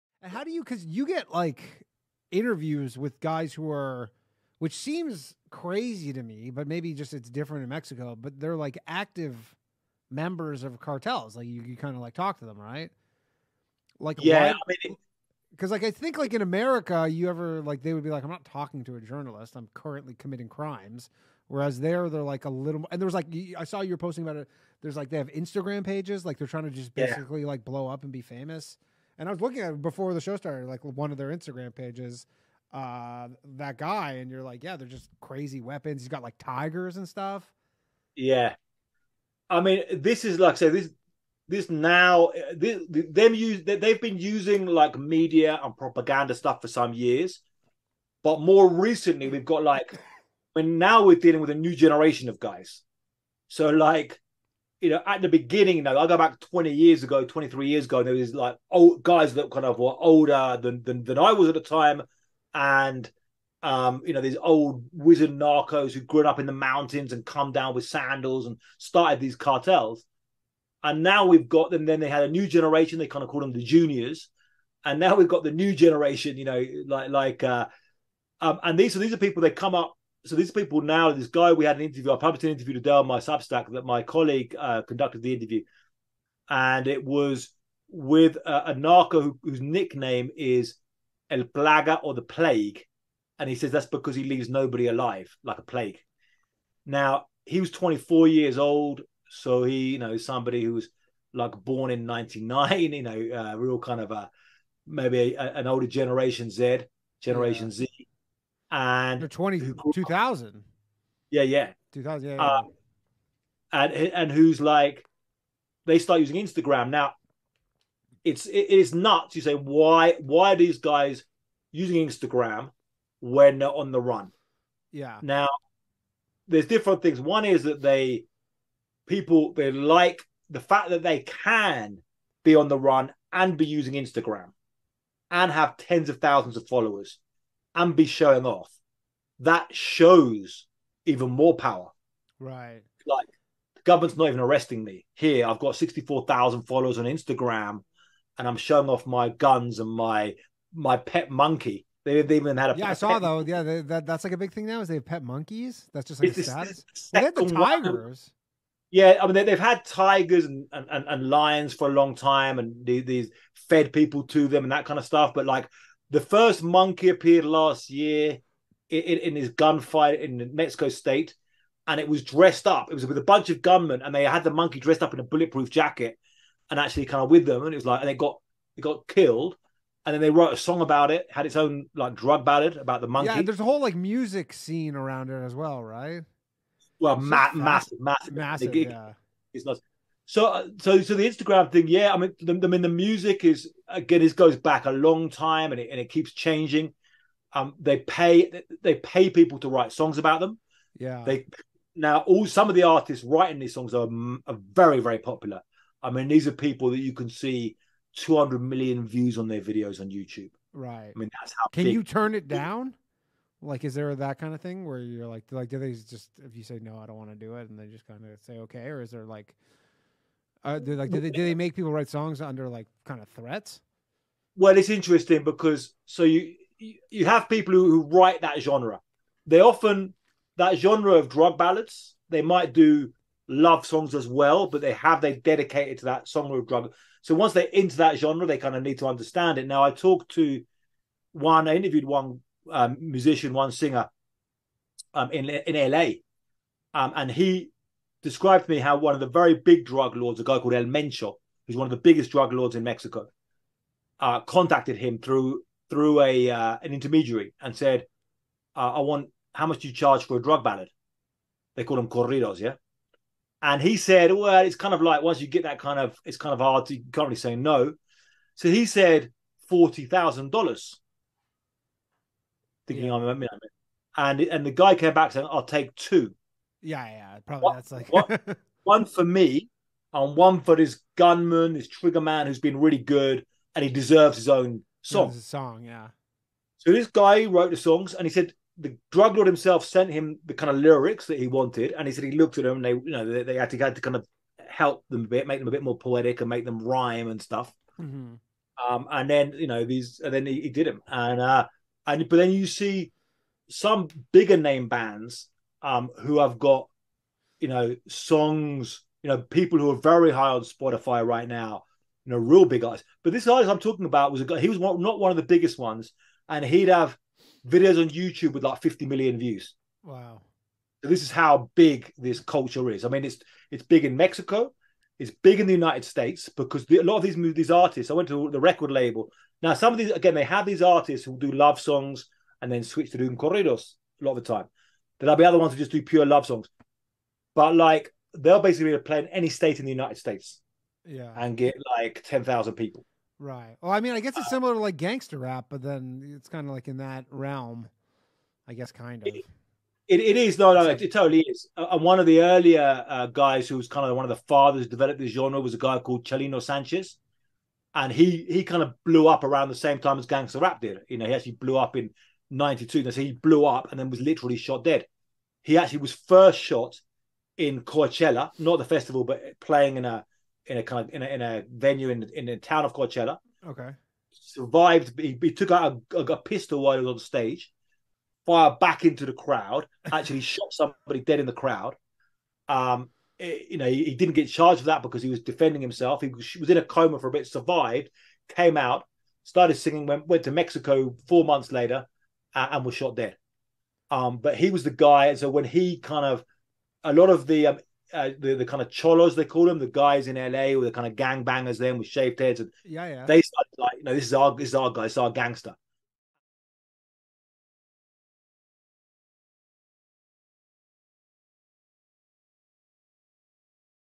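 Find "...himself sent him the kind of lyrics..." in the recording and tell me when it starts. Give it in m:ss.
4:49.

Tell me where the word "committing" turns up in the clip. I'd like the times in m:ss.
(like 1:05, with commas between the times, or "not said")
0:20.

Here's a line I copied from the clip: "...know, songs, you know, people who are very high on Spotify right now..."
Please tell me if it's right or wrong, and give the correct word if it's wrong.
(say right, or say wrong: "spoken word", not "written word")
right.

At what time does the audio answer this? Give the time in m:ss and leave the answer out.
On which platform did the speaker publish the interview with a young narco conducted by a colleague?
1:23.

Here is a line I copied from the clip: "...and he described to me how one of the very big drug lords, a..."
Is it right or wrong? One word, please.
right.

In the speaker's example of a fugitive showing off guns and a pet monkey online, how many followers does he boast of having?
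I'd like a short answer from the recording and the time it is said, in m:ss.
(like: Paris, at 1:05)
64,000, at 2:25.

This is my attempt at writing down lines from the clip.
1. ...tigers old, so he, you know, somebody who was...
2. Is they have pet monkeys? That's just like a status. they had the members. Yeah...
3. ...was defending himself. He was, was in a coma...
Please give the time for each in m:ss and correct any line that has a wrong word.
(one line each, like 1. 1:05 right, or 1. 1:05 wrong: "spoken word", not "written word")
1. 1:38 wrong: "years", not "tigers"
2. 2:34 wrong: "tigers", not "members"
3. 6:25 right.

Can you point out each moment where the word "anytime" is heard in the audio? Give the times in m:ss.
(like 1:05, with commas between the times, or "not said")
not said.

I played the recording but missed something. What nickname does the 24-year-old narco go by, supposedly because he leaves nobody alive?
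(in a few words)
El Plaga.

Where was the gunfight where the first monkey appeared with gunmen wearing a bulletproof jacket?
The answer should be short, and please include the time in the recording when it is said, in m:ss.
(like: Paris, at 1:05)
Mexico State, at 2:50.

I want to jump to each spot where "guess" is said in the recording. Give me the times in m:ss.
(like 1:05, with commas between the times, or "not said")
5:44, 5:48.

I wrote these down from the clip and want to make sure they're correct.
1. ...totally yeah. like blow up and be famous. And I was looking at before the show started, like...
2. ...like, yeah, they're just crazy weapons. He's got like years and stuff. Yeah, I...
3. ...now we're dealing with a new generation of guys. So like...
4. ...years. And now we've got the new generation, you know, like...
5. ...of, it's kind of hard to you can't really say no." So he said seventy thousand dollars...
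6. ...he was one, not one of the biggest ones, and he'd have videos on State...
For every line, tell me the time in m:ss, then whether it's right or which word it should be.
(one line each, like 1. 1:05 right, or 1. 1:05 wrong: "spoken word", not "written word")
1. 0:26 wrong: "basically", not "totally"
2. 0:34 wrong: "tigers", not "years"
3. 0:50 right
4. 1:13 wrong: "juniors", not "years"
5. 4:25 wrong: "forty", not "seventy"
6. 5:14 wrong: "YouTube", not "State".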